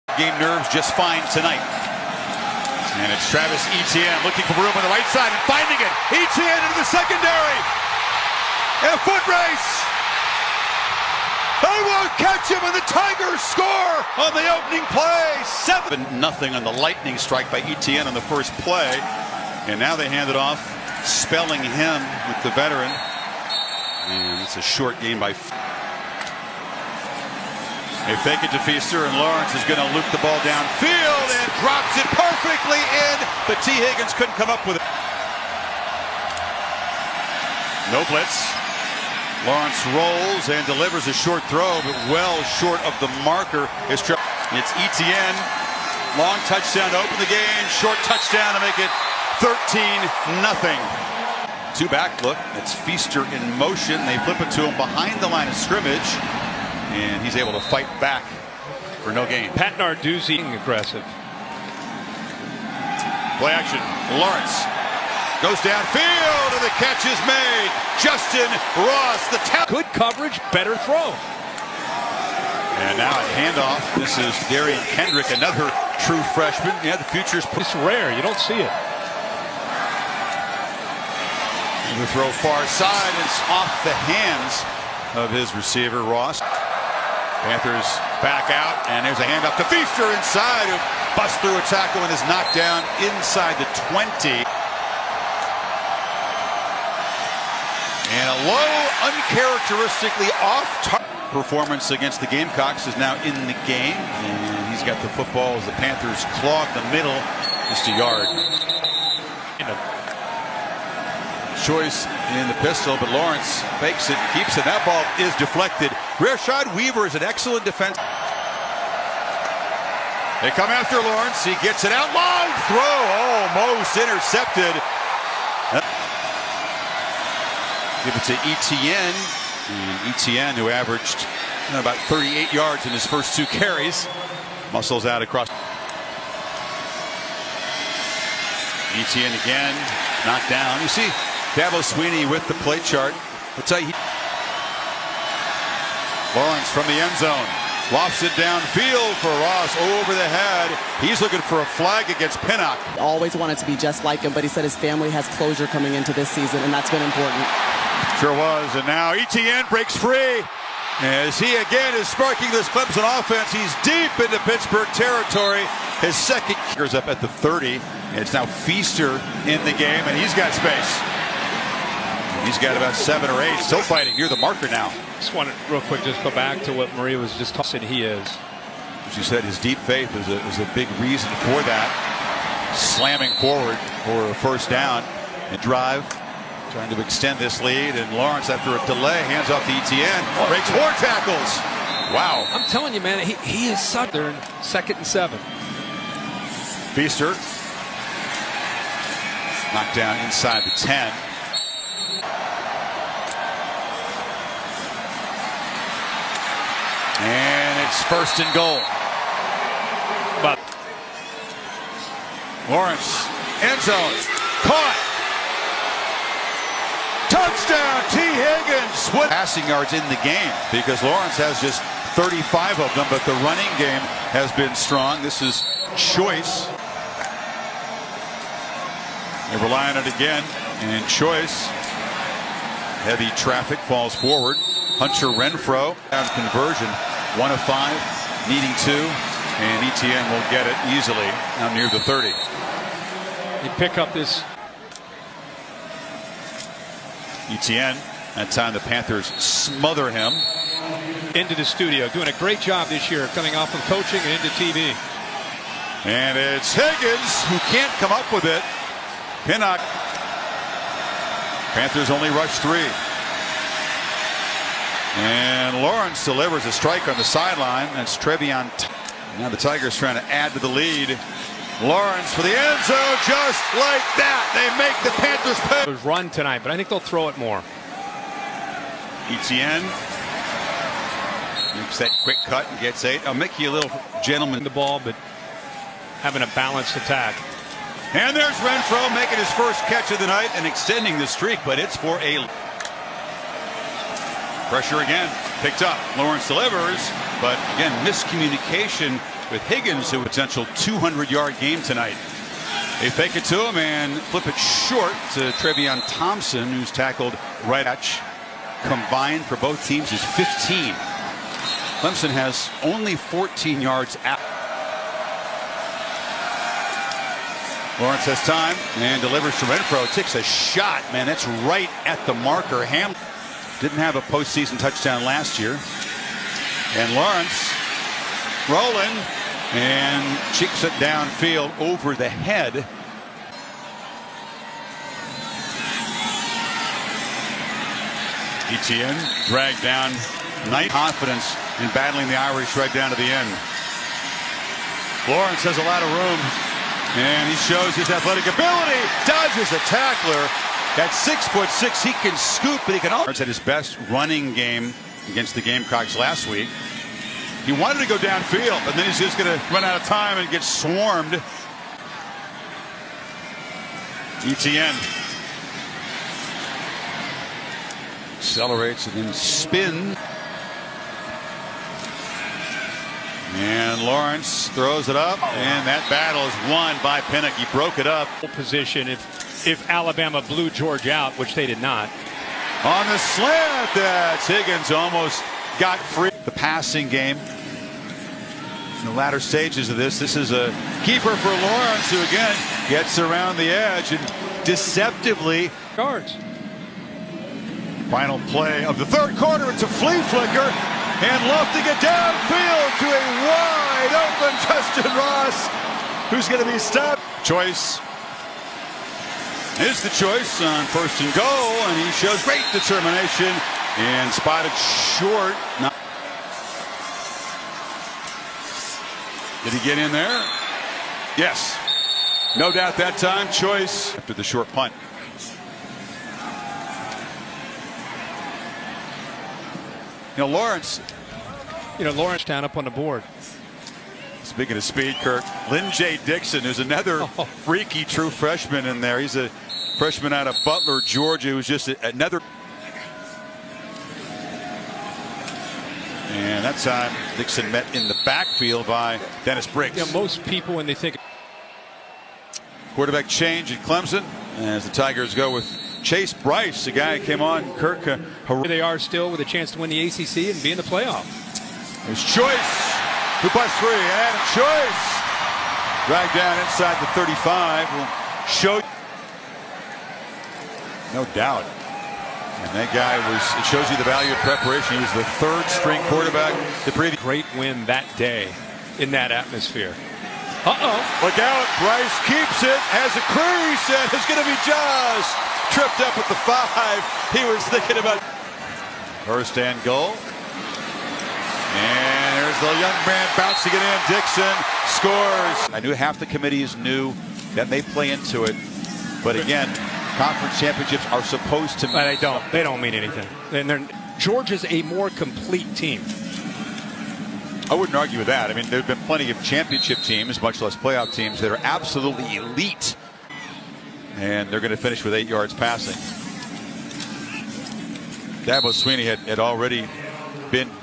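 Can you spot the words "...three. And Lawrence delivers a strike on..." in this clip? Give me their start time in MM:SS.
04:22.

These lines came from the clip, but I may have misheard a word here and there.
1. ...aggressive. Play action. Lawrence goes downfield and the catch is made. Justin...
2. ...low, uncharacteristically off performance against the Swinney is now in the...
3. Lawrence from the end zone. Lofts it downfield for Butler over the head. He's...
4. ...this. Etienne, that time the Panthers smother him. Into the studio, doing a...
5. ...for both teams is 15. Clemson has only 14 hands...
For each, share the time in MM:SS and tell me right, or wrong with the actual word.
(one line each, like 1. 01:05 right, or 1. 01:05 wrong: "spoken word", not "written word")
1. 01:00 right
2. 01:38 wrong: "Gamecocks", not "Swinney"
3. 02:26 wrong: "Ross", not "Butler"
4. 04:04 right
5. 05:09 wrong: "yards", not "hands".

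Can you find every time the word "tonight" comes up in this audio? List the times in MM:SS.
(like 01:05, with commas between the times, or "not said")
00:01, 04:36, 05:01.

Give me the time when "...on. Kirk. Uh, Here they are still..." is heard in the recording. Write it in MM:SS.
07:37.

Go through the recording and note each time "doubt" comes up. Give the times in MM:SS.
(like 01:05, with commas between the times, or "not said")
07:02, 07:51.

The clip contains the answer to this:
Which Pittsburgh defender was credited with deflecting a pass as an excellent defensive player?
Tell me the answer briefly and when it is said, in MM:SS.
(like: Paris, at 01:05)
Rashad Weaver, at 01:56.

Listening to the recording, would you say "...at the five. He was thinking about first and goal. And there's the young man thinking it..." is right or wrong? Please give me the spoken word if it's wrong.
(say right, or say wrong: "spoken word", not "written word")
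wrong: "bouncing", not "thinking".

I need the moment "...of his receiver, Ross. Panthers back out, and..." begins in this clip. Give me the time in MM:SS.
01:25.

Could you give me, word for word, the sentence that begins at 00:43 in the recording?
It's Etienne, Long touchdown to open the game.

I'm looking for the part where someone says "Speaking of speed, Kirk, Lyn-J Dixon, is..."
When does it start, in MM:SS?
07:14.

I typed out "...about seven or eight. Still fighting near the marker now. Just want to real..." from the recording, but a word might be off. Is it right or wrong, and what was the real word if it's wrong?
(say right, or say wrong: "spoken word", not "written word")
right.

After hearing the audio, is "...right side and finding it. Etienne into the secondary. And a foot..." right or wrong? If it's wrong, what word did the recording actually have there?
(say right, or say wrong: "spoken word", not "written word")
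right.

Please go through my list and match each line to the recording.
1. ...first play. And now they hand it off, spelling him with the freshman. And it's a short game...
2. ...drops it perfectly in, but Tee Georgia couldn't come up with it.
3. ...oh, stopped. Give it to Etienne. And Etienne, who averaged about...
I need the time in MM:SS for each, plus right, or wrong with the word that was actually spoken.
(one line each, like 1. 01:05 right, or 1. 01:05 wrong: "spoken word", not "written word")
1. 00:18 wrong: "veteran", not "freshman"
2. 00:31 wrong: "Higgins", not "Georgia"
3. 02:03 wrong: "intercepted", not "stopped".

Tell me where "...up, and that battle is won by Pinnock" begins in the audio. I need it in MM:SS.
06:15.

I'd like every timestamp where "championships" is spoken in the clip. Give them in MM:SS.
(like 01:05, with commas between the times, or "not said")
08:20, 08:29.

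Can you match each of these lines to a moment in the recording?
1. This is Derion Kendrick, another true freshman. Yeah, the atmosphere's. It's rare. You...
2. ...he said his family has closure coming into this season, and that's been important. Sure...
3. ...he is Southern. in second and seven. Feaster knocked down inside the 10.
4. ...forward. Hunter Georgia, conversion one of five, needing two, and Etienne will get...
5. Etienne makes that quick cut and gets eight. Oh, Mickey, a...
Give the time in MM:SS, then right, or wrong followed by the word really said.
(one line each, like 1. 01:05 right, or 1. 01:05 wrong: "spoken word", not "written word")
1. 01:13 wrong: "future", not "atmosphere"
2. 02:34 right
3. 03:13 right
4. 03:54 wrong: "Renfrow", not "Georgia"
5. 04:39 right.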